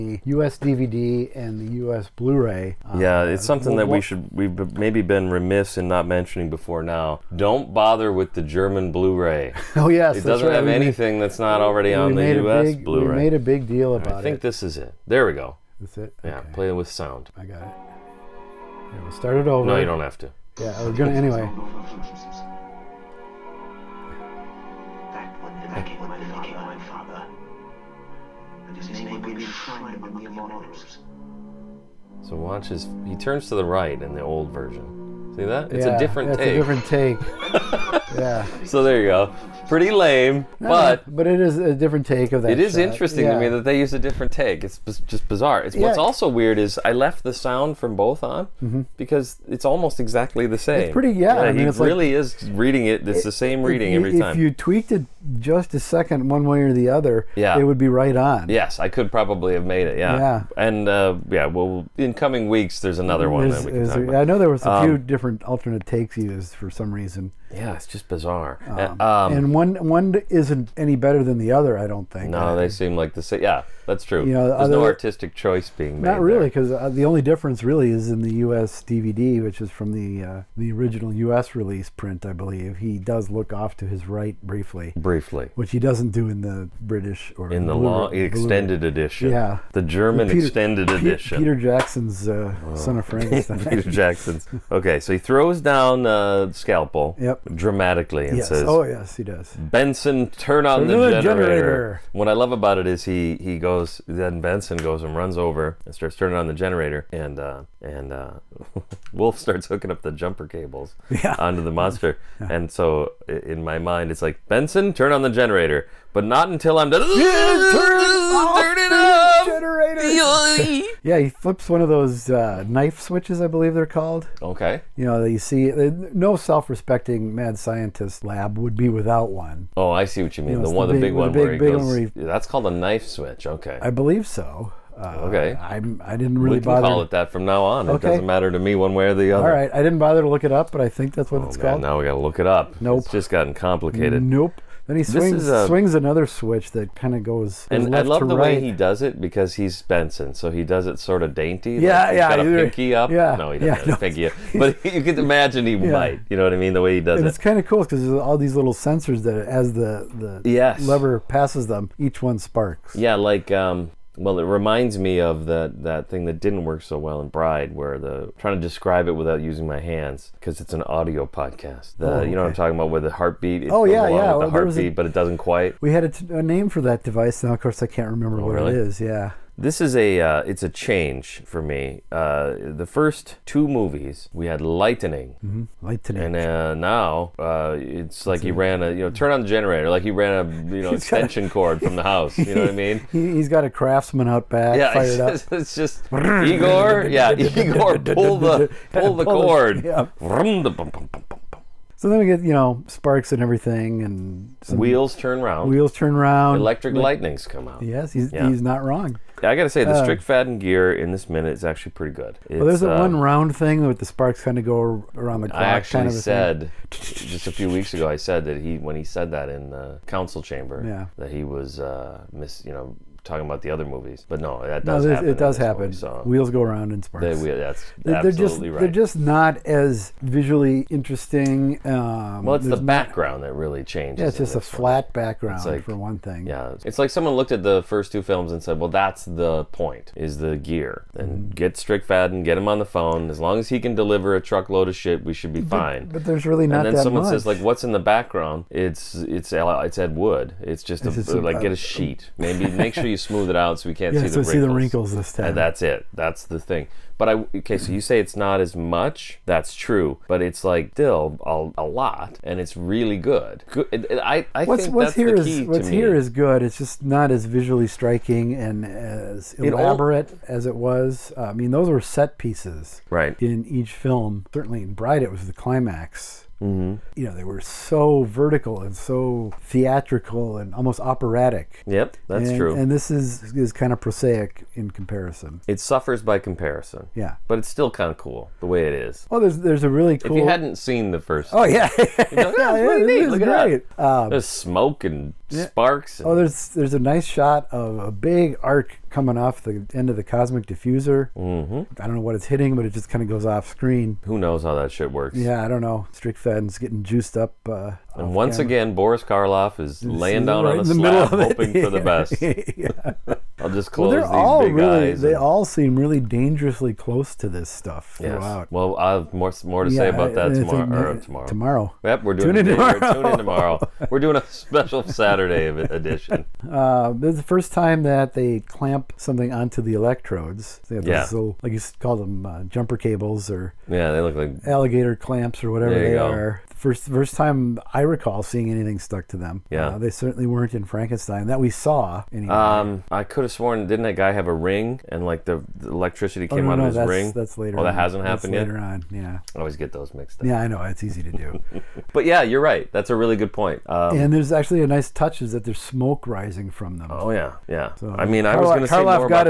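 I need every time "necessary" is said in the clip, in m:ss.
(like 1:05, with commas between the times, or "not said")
not said.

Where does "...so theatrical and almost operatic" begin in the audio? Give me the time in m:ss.
4:38.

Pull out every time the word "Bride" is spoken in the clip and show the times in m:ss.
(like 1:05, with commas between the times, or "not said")
2:47, 4:34.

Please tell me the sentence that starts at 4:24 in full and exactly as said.
I, I what's, think what's that's here the key is, what's me.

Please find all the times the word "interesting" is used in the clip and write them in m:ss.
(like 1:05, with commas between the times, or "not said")
0:42, 3:50.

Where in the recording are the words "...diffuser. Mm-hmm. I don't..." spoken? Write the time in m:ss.
5:00.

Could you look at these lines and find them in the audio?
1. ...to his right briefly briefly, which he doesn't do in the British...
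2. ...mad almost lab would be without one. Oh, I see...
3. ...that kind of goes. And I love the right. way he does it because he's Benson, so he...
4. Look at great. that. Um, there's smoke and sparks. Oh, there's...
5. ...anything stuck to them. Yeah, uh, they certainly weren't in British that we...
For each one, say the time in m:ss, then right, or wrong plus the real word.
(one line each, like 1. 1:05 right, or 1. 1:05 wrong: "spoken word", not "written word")
1. 1:23 right
2. 2:07 wrong: "scientist", not "almost"
3. 2:26 right
4. 4:53 right
5. 5:38 wrong: "Frankenstein", not "British".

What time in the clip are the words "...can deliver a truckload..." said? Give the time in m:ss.
4:03.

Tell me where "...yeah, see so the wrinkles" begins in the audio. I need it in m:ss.
4:14.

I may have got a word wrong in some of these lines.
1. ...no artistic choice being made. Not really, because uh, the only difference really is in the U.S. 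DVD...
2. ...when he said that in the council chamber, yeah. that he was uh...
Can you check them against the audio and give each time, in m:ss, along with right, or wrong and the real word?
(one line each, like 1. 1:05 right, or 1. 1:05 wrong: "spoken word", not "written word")
1. 1:14 right
2. 3:38 right.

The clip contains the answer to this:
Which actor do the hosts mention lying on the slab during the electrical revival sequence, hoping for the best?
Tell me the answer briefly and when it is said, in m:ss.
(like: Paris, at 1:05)
Boris Karloff, at 5:08.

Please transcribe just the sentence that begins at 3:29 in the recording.
I got to say, the uh, strict Fadden gear in this minute is actually pretty good.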